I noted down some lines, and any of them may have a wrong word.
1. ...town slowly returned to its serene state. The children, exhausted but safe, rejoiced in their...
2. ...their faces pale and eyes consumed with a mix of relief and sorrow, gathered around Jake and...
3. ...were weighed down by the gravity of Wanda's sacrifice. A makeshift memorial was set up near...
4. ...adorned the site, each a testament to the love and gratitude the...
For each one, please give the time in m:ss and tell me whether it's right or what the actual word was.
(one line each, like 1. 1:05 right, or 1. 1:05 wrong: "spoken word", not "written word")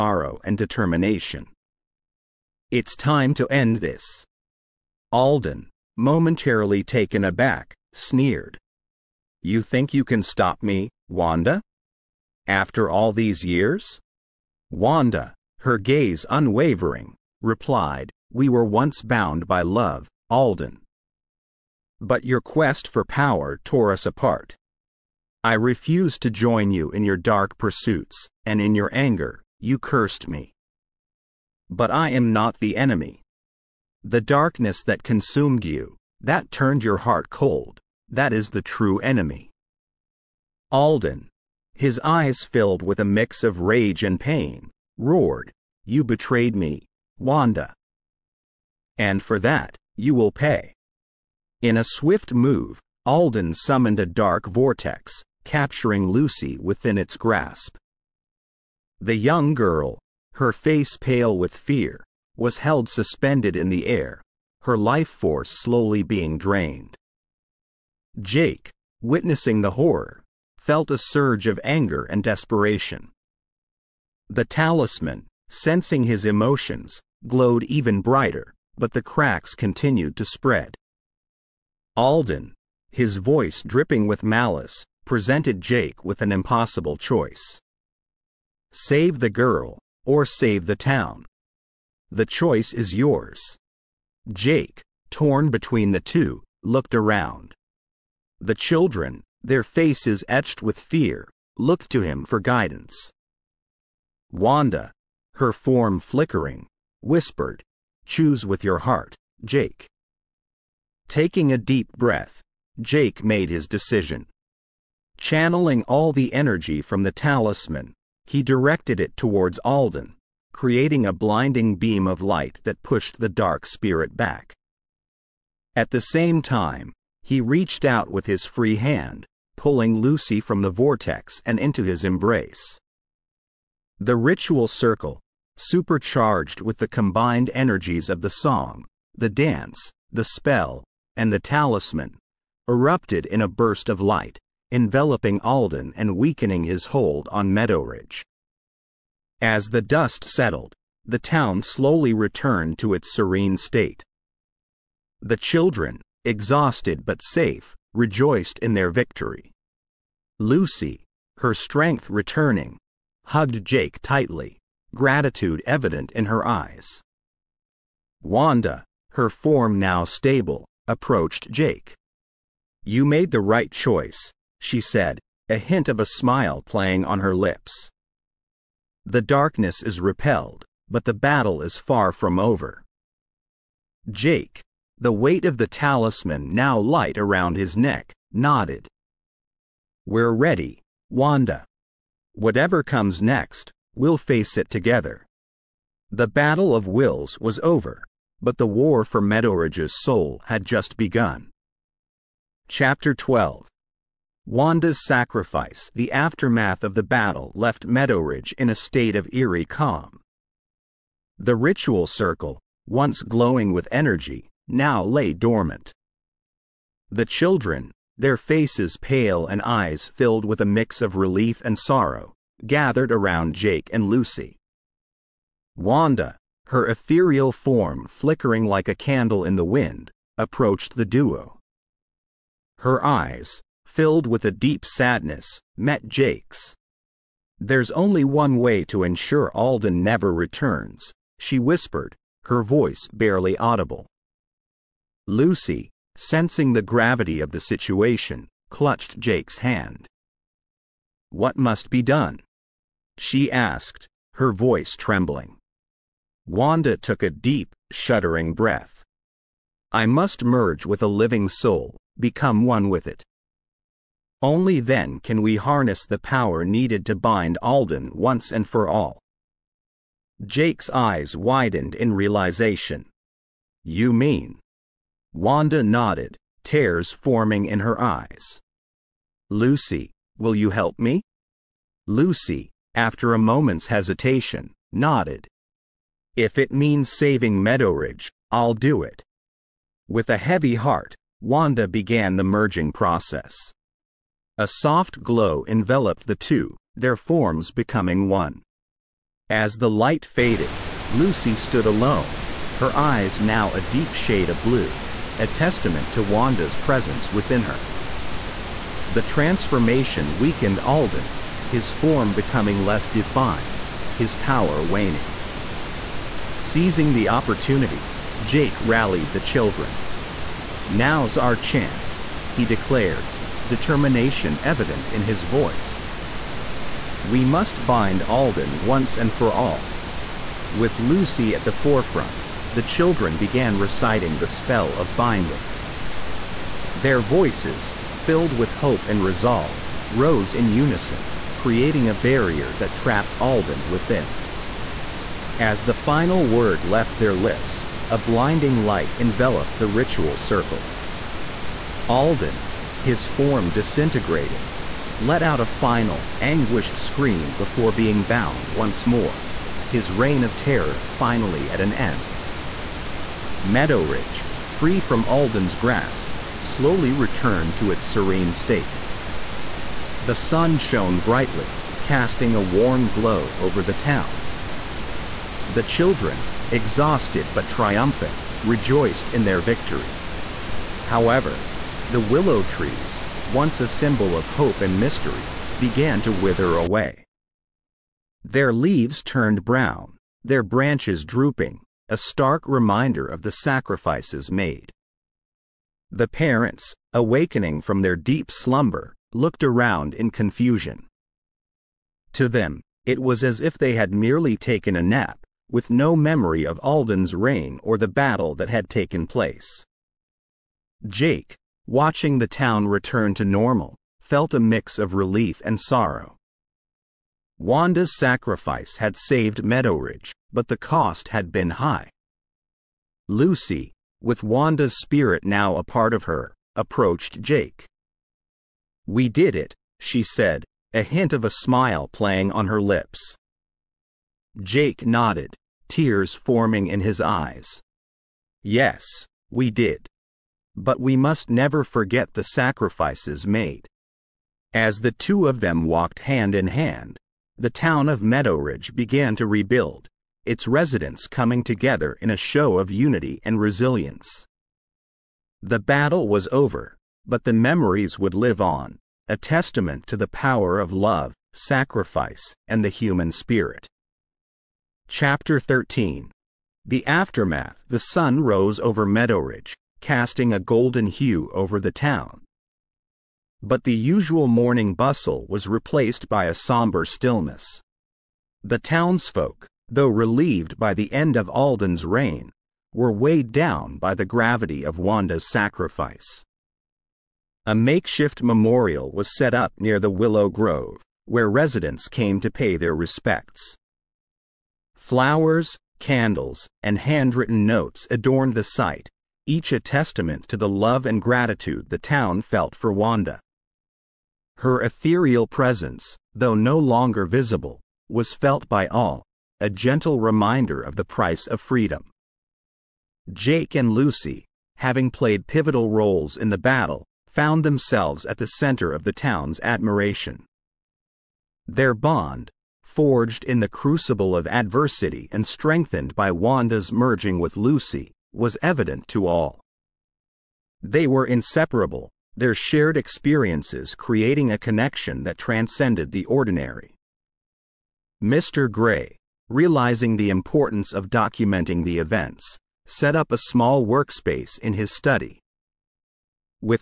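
1. 2:31 right
2. 3:38 wrong: "filled", not "consumed"
3. 8:02 right
4. 8:18 right.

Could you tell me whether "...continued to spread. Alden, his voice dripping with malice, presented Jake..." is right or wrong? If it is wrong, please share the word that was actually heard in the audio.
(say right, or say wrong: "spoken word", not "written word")
right.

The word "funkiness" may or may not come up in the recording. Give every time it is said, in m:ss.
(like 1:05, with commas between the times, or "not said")
not said.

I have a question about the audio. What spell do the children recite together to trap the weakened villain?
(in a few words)
The spell of binding.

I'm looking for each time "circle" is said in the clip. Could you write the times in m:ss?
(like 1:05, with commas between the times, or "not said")
2:14, 3:32, 5:50.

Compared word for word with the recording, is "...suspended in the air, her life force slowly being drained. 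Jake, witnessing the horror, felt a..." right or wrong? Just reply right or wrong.
right.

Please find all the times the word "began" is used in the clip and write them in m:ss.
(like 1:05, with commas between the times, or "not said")
4:51, 5:33, 6:25, 7:28.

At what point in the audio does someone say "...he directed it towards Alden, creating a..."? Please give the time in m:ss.
1:58.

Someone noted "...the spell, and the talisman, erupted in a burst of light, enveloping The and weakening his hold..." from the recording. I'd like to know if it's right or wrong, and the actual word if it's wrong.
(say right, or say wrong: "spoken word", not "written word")
wrong: "Alden", not "The".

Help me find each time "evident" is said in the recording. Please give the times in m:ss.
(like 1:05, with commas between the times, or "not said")
2:45, 5:24, 8:48.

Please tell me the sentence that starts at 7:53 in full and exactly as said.
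But the usual morning bustle was replaced by a somber stillness.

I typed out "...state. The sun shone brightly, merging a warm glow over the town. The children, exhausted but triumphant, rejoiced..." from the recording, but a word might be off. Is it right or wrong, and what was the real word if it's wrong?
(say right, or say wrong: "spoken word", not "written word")
wrong: "casting", not "merging".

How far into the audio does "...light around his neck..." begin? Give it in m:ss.
3:06.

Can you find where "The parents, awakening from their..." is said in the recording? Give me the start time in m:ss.
6:36.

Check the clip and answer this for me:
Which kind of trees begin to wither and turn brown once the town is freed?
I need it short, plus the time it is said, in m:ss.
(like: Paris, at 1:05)
Willow trees, at 6:22.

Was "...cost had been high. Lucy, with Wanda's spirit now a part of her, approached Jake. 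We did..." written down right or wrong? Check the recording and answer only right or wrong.
right.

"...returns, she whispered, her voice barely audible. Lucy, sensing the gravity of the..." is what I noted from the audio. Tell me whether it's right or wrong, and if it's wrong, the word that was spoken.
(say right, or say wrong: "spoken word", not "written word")
right.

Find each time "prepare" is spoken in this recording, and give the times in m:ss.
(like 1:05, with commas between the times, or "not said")
not said.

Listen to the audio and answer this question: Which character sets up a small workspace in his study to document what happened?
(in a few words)
Mr. Gray.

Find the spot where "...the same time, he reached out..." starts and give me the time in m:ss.
2:05.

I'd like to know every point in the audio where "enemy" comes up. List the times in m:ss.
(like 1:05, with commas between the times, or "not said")
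0:32, 0:38.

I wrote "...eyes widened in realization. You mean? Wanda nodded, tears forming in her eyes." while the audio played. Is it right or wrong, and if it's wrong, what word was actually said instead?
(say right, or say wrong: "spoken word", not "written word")
right.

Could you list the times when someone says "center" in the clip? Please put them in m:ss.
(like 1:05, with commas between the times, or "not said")
8:38.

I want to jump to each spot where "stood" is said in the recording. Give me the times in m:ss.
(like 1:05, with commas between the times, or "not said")
5:01.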